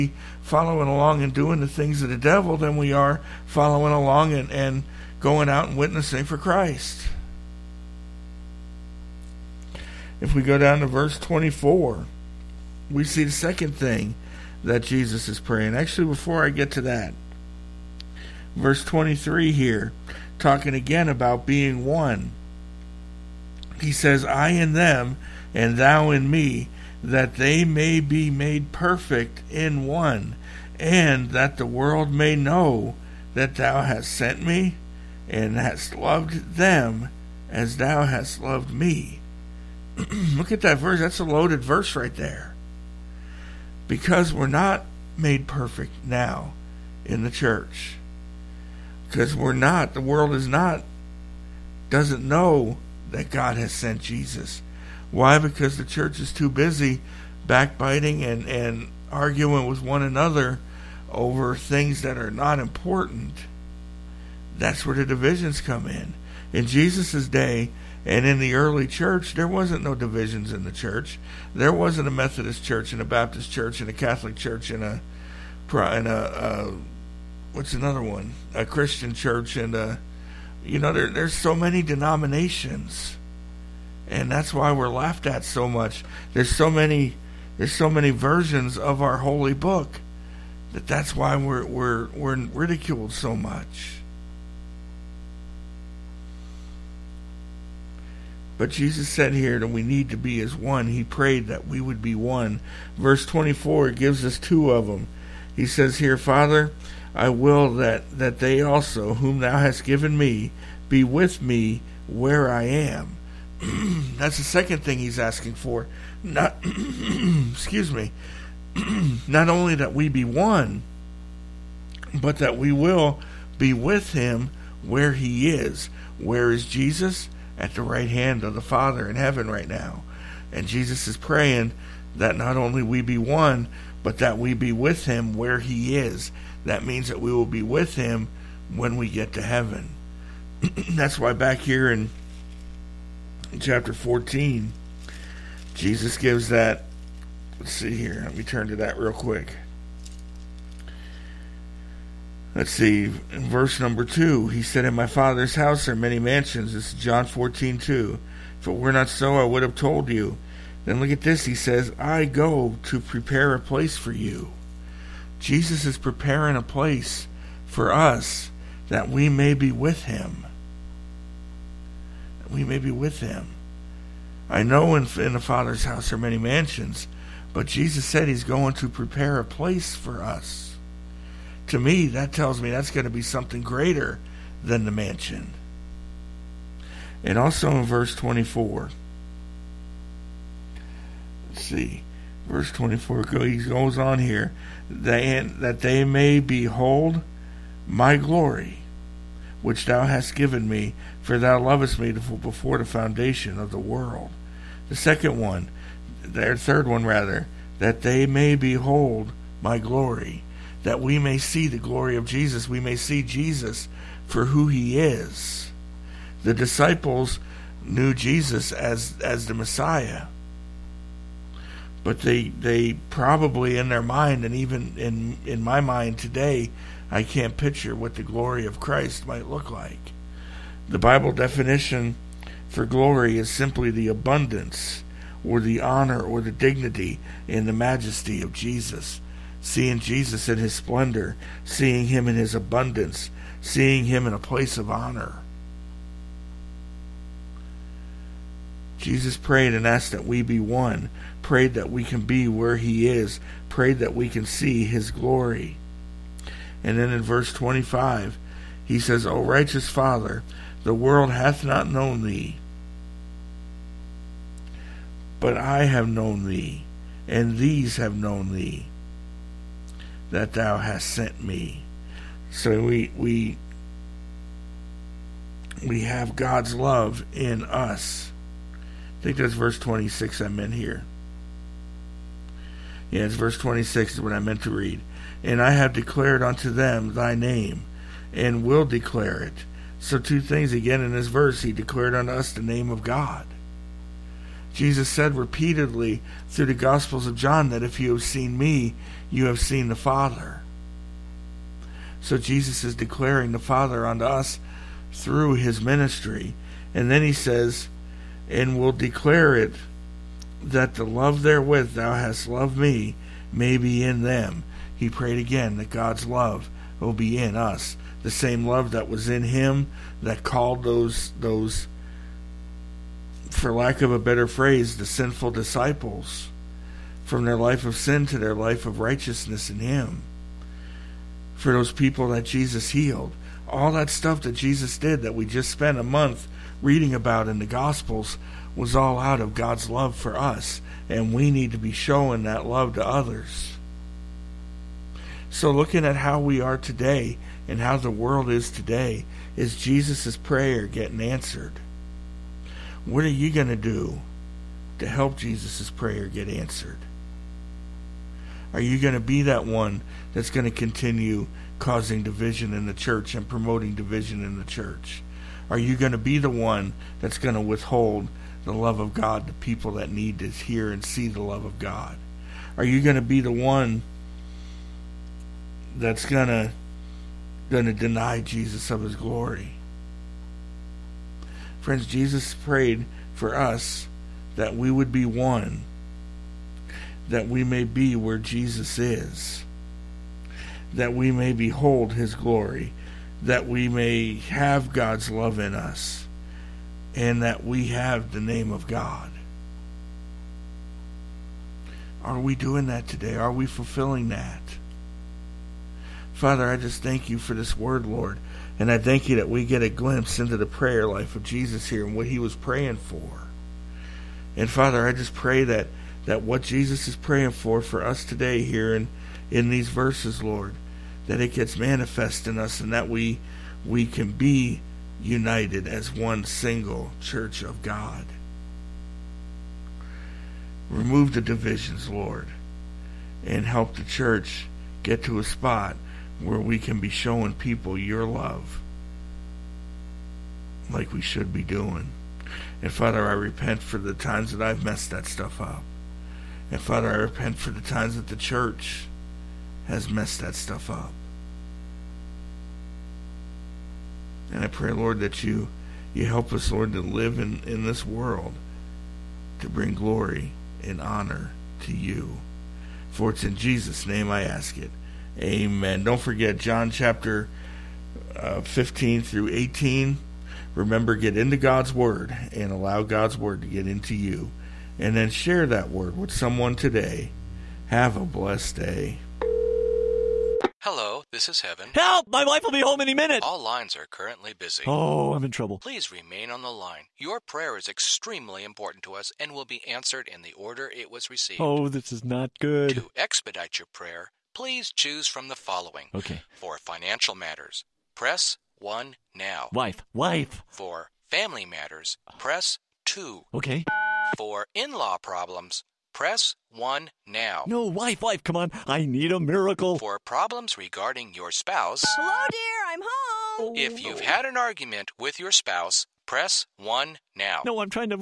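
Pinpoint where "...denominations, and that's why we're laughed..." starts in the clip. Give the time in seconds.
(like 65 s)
81 s.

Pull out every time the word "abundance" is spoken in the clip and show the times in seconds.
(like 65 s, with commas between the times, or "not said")
234 s, 242 s.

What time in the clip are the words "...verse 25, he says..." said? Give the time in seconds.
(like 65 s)
257 s.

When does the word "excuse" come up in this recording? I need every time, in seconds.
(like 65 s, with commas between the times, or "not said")
117 s.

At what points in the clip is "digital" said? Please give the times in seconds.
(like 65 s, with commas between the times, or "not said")
not said.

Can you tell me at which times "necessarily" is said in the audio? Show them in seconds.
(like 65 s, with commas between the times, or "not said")
not said.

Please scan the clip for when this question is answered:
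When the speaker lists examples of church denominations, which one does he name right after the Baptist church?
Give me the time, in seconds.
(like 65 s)
73 s.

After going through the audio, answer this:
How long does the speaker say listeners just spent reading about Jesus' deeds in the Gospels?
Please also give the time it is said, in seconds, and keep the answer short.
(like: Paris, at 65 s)
a month, at 335 s.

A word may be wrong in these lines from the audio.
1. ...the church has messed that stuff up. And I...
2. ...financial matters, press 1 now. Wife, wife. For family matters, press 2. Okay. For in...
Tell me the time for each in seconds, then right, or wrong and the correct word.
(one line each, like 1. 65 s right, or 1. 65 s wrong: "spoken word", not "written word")
1. 448 s right
2. 496 s right.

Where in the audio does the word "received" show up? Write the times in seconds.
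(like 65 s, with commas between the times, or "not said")
491 s.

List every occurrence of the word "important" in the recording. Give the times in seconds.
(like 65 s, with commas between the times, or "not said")
62 s, 488 s.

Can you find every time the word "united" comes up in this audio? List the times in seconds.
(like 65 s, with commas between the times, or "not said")
425 s.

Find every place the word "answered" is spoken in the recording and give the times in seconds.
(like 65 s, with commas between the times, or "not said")
351 s, 356 s, 489 s.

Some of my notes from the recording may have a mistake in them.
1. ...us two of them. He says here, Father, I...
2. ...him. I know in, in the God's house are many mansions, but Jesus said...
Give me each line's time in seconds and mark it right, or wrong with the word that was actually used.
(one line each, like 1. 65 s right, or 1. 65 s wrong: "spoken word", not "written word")
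1. 104 s right
2. 173 s wrong: "Father", not "God".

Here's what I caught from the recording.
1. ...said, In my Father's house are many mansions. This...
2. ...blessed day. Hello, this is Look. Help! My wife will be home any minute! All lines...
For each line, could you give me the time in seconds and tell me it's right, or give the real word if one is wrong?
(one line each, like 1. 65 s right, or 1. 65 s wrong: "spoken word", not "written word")
1. 154 s right
2. 478 s wrong: "Heaven", not "Look".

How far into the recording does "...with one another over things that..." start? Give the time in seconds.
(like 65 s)
59 s.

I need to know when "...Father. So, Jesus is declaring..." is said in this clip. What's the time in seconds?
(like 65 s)
299 s.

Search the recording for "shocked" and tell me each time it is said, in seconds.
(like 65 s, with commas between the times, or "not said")
not said.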